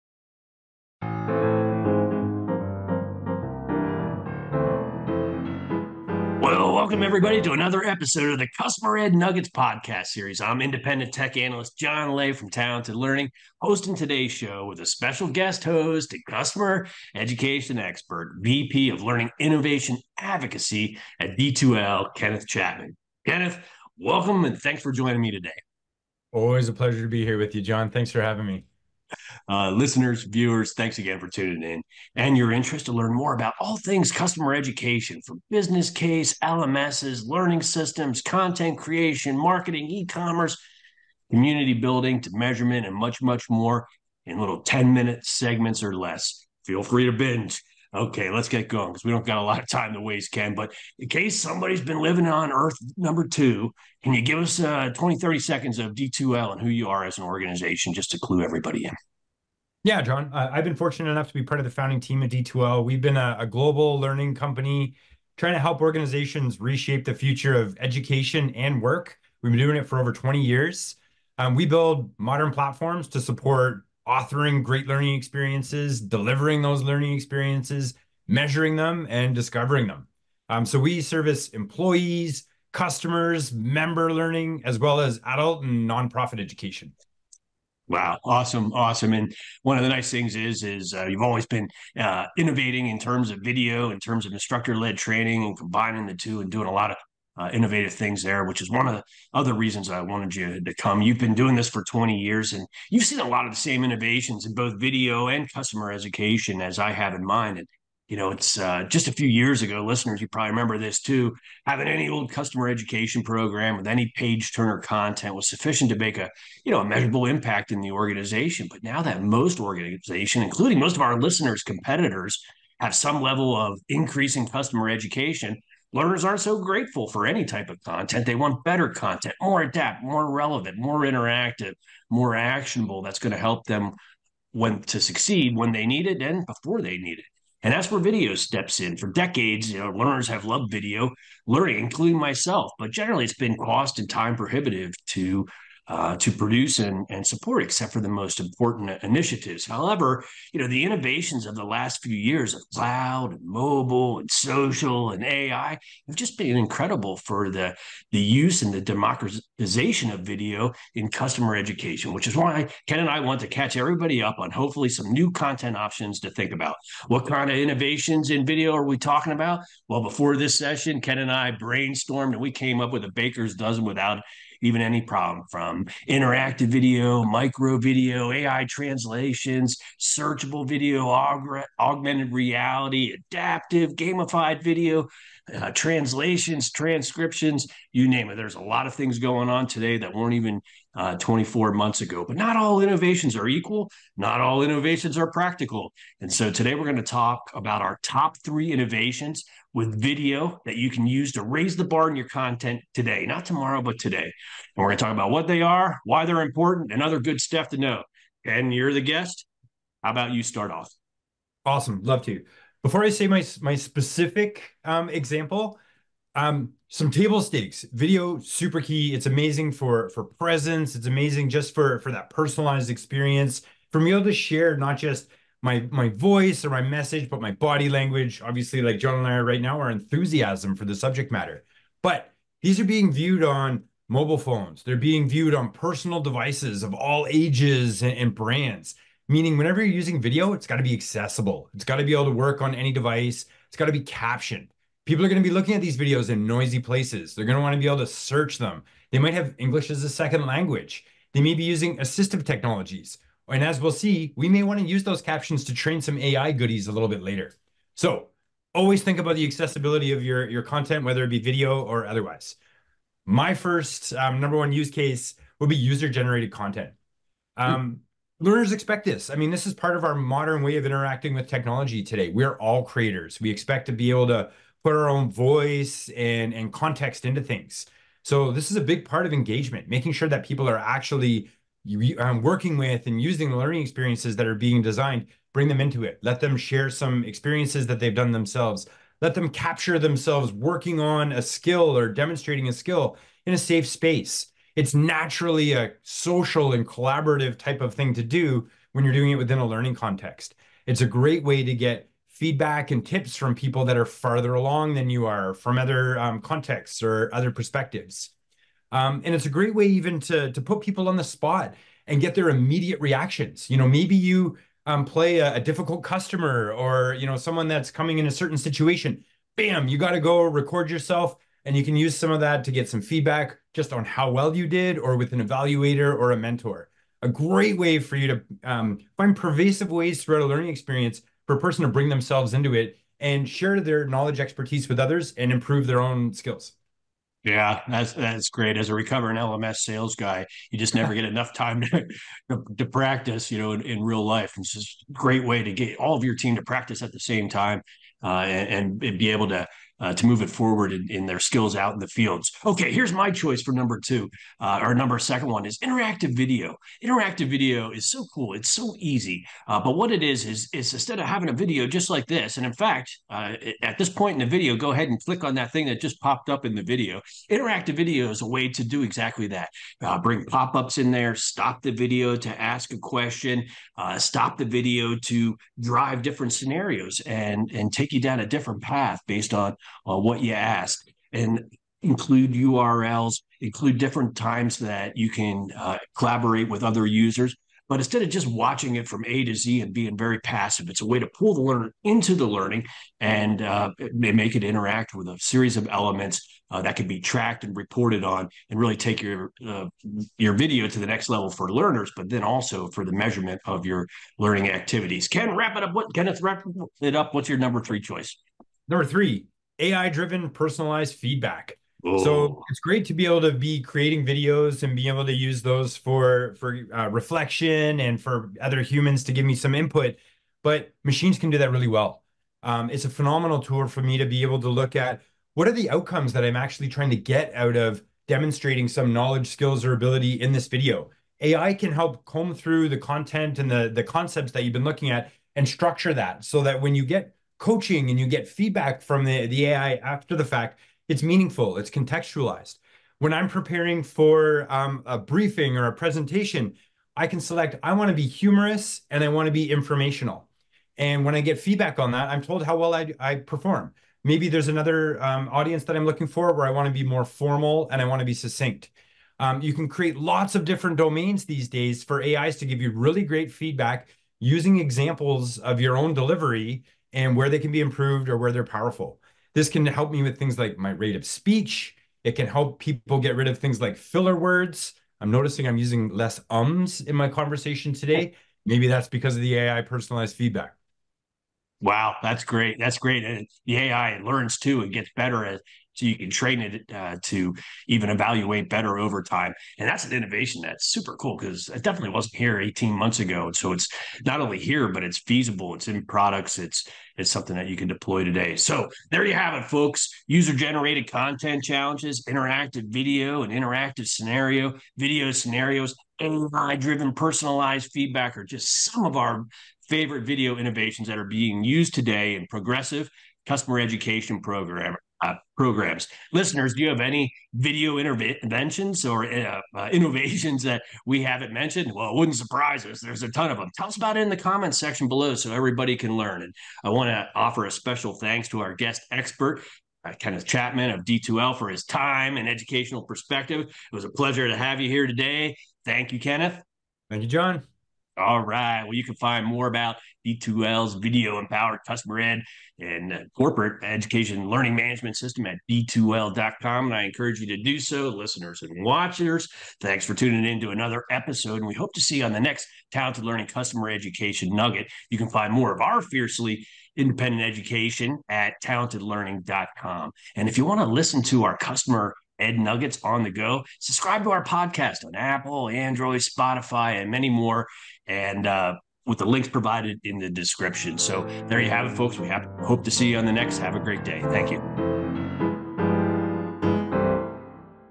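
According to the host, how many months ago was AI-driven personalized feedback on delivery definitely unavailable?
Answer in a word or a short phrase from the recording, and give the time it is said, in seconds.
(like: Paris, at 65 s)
18, at 492 s.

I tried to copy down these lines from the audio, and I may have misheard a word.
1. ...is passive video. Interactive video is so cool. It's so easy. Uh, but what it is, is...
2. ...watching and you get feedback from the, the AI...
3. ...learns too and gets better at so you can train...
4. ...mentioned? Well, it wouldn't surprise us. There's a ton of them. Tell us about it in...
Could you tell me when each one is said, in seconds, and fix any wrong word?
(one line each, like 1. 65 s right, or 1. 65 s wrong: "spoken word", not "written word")
1. 355 s wrong: "interactive", not "passive"
2. 437 s wrong: "coaching", not "watching"
3. 484 s right
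4. 521 s right.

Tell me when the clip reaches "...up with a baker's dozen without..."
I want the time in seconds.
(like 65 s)
172 s.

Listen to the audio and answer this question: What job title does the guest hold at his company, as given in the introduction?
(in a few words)
VP of Learning Innovation Advocacy.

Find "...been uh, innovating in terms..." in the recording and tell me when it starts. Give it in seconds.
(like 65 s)
91 s.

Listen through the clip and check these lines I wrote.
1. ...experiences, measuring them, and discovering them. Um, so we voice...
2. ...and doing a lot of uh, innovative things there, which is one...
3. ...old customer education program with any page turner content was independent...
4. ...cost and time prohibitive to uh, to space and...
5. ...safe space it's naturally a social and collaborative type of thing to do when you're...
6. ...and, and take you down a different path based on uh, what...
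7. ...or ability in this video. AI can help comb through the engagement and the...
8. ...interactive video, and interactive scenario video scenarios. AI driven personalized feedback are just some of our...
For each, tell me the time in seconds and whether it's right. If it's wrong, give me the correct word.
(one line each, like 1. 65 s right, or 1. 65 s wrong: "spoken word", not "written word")
1. 77 s wrong: "service", not "voice"
2. 96 s right
3. 112 s wrong: "sufficient", not "independent"
4. 143 s wrong: "produce", not "space"
5. 293 s right
6. 377 s right
7. 429 s wrong: "content", not "engagement"
8. 502 s right.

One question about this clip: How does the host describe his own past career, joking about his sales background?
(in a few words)
recovering LMS sales guy.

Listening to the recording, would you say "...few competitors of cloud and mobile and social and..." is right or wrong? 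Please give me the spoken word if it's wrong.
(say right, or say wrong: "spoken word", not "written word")
wrong: "years", not "competitors".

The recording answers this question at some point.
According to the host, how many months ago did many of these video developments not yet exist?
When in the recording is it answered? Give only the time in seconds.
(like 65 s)
191 s.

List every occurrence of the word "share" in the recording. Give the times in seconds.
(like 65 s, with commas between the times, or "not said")
224 s, 286 s, 333 s.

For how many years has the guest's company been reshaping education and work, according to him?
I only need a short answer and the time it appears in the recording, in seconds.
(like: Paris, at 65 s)
20, at 69 s.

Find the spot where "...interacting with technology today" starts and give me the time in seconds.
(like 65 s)
270 s.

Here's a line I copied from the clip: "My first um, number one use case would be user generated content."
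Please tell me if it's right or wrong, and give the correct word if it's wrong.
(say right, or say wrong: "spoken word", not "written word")
right.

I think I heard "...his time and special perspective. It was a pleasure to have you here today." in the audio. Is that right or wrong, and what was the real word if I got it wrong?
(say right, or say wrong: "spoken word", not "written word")
wrong: "educational", not "special".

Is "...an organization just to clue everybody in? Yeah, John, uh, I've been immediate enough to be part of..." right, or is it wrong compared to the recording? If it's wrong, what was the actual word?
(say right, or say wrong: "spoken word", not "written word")
wrong: "fortunate", not "immediate".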